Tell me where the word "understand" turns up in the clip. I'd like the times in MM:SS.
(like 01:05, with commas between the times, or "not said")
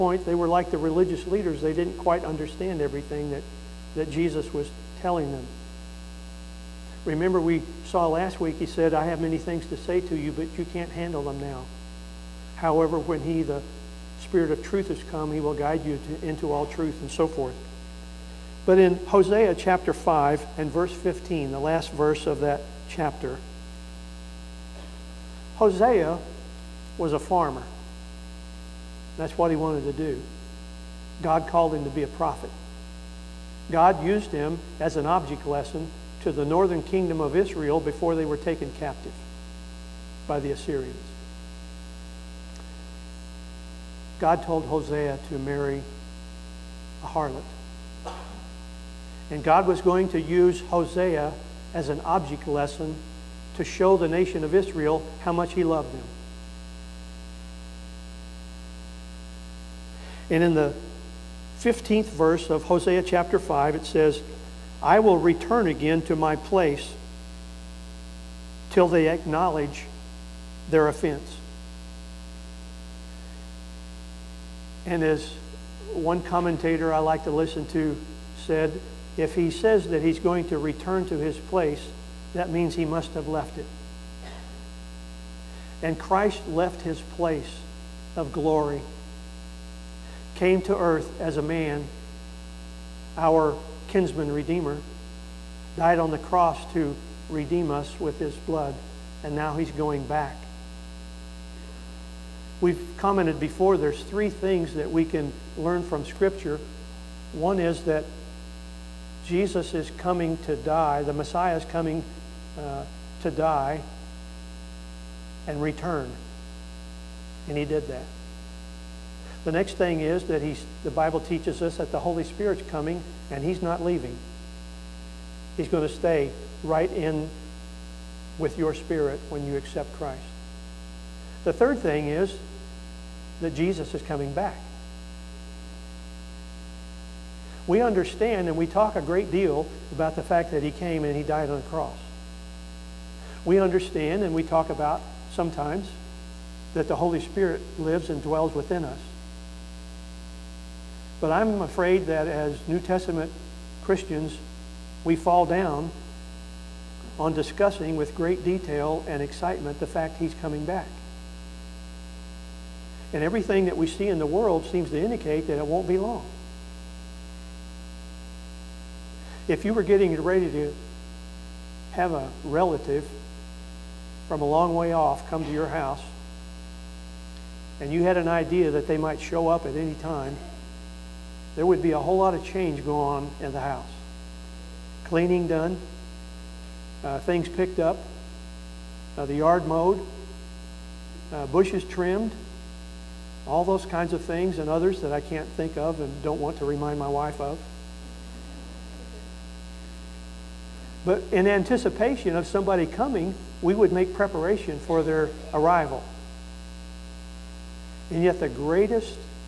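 00:02, 02:17, 02:23.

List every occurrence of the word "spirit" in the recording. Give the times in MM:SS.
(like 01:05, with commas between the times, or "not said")
00:14, 02:02, 02:08, 02:27.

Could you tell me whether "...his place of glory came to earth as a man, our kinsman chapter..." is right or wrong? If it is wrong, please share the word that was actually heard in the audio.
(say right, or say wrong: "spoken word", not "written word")
wrong: "redeemer", not "chapter".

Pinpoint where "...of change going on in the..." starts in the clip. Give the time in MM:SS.
03:02.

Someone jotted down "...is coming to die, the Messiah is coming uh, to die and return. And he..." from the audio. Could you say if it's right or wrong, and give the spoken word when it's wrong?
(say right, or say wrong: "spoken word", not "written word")
right.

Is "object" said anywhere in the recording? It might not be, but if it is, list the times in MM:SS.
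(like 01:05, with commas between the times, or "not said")
00:35, 00:52.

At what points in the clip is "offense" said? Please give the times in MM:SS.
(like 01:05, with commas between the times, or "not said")
01:10.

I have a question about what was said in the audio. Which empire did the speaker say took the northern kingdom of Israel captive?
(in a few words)
The Assyrians.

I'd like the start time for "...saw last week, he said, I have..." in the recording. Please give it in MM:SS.
00:07.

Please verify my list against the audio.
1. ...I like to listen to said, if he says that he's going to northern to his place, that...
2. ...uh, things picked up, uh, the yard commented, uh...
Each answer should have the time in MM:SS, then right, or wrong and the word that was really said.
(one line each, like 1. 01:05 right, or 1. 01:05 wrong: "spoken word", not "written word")
1. 01:16 wrong: "return", not "northern"
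2. 03:07 wrong: "mowed", not "commented".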